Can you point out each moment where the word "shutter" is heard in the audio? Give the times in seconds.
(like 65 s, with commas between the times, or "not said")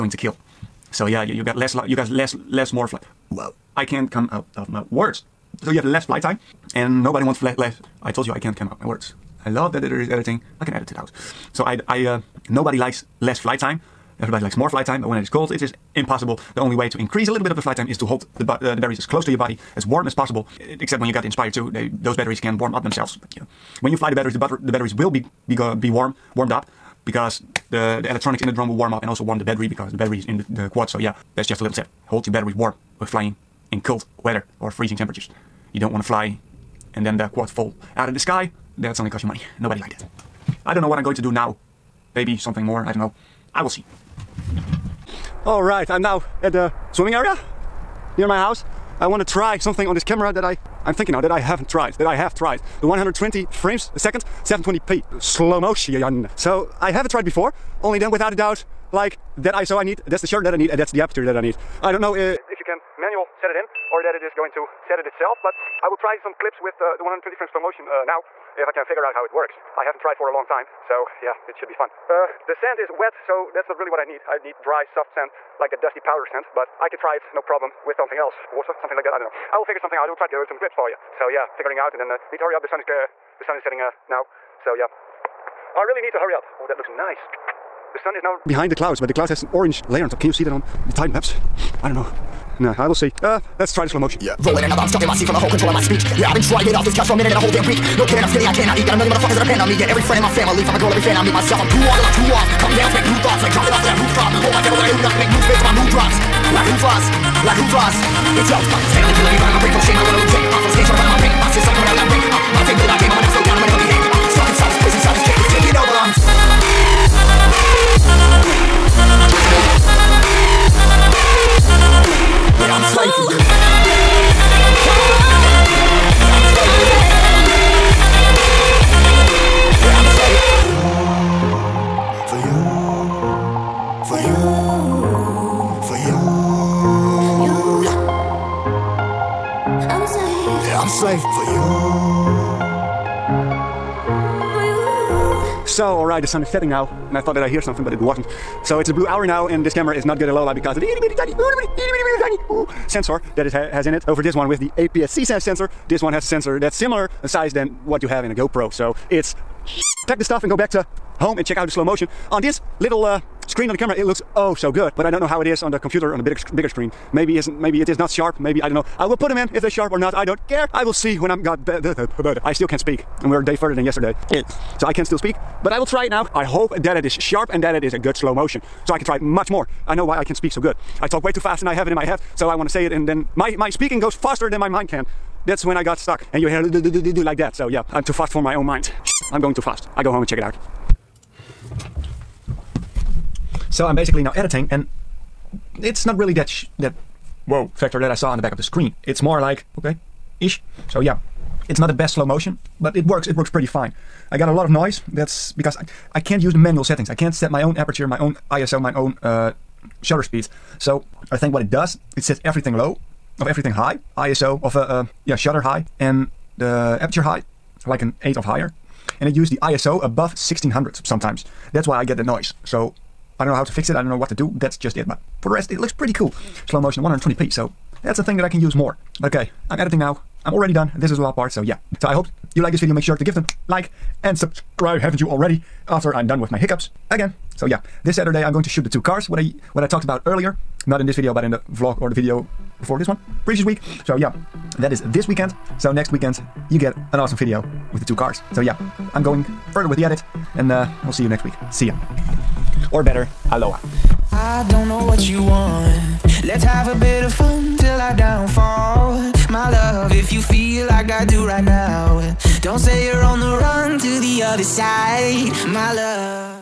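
60 s, 210 s, 215 s.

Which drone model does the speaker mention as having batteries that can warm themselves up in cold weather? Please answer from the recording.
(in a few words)
Inspire 2.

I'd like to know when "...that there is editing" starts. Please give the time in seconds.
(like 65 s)
9 s.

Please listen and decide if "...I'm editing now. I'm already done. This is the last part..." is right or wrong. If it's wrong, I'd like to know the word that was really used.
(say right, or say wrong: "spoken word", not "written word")
right.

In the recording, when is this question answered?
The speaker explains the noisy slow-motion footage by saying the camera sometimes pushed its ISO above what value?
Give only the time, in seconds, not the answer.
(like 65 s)
220 s.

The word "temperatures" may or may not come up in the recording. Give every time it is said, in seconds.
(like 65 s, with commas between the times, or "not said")
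34 s.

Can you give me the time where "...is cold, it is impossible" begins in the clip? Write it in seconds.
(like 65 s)
15 s.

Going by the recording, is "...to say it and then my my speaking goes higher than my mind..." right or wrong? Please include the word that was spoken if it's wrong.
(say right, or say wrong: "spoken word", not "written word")
wrong: "faster", not "higher".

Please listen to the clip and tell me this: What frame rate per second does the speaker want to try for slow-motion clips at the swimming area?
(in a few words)
120.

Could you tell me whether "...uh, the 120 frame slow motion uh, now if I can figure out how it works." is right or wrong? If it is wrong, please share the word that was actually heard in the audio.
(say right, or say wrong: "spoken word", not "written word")
right.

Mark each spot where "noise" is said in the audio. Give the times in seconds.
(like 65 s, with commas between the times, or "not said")
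204 s, 222 s.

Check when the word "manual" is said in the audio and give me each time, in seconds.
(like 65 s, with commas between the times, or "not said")
62 s, 206 s.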